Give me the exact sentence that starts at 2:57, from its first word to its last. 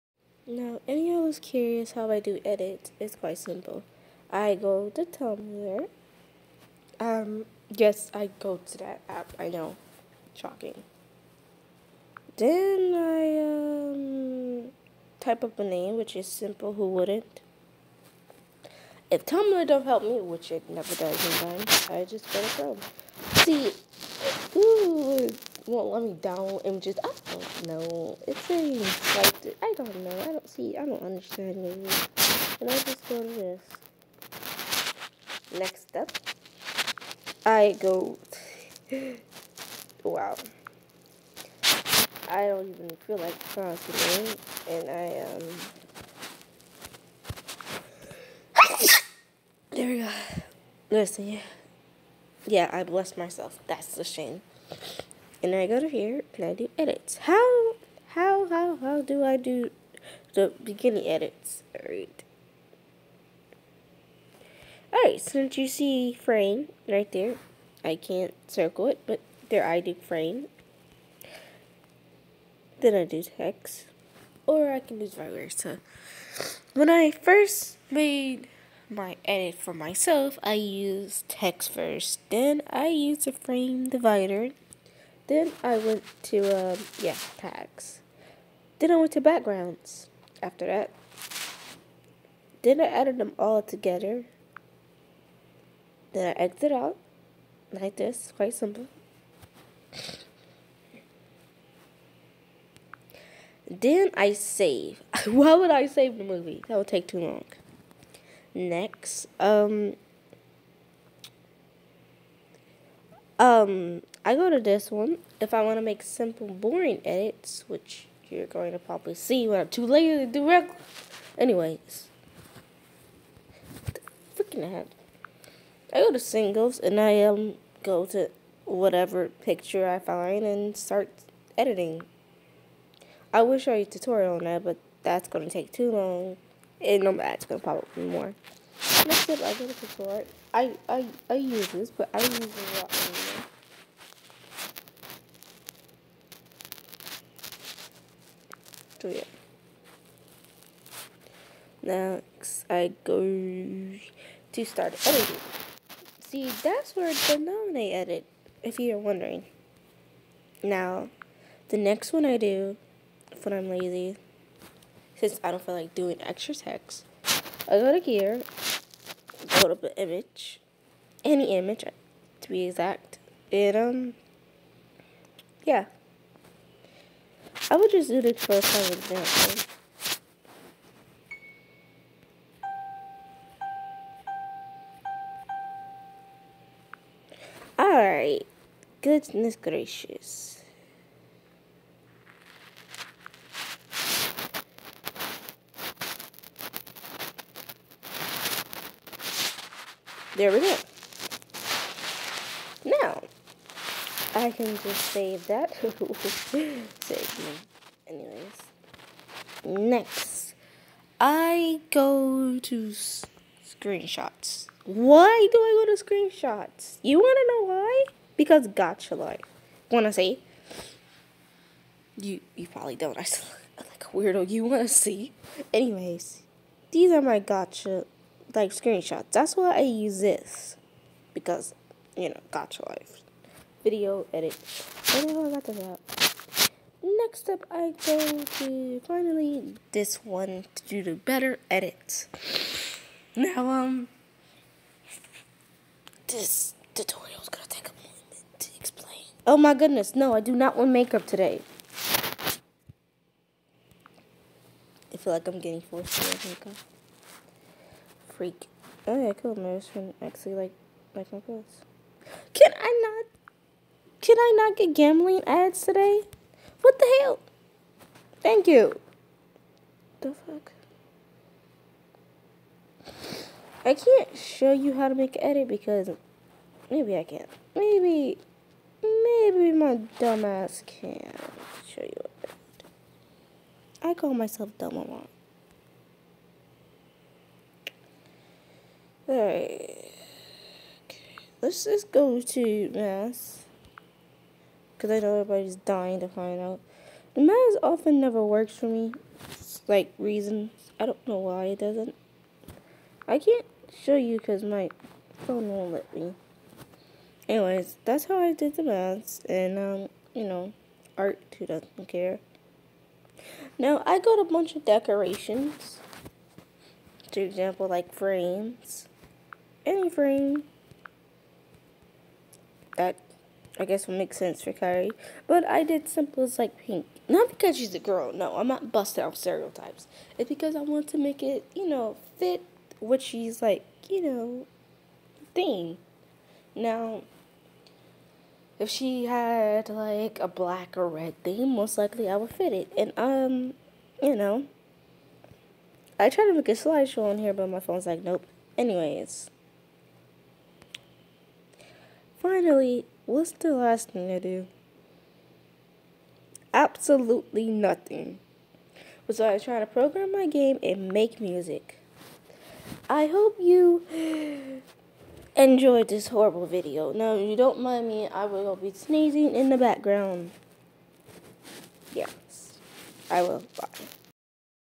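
I would just do this for some example.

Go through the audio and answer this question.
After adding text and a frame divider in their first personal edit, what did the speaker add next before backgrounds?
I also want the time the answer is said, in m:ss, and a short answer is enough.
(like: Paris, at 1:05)
tags, at 1:27.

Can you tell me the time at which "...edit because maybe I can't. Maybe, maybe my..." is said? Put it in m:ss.
4:35.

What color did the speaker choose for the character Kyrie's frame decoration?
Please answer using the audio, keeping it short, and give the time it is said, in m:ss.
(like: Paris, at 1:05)
Pink, at 5:26.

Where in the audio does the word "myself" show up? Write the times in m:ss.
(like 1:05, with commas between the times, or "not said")
0:53, 1:19, 4:44.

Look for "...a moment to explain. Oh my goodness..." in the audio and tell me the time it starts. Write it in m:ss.
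4:07.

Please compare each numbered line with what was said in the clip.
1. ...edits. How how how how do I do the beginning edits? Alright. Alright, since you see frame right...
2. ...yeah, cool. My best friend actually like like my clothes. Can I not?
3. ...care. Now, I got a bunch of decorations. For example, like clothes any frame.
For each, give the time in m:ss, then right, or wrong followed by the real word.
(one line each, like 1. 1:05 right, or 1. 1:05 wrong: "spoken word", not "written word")
1. 0:56 right
2. 4:19 right
3. 5:12 wrong: "frames", not "clothes".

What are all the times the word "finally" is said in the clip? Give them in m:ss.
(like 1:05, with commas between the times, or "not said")
3:59, 5:52.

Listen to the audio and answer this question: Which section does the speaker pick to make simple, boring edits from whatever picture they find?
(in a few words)
singles.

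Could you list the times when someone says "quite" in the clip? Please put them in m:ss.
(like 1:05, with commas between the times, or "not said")
0:03, 1:38.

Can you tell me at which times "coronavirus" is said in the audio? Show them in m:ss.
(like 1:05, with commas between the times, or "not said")
not said.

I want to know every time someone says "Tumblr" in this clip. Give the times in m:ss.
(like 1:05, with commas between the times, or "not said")
0:05, 0:19.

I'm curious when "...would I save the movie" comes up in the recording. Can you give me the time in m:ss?
1:45.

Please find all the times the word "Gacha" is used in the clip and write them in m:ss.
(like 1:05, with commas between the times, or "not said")
3:38, 3:47, 3:52.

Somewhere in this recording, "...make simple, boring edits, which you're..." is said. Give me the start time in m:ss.
1:55.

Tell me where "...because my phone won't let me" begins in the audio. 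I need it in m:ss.
5:04.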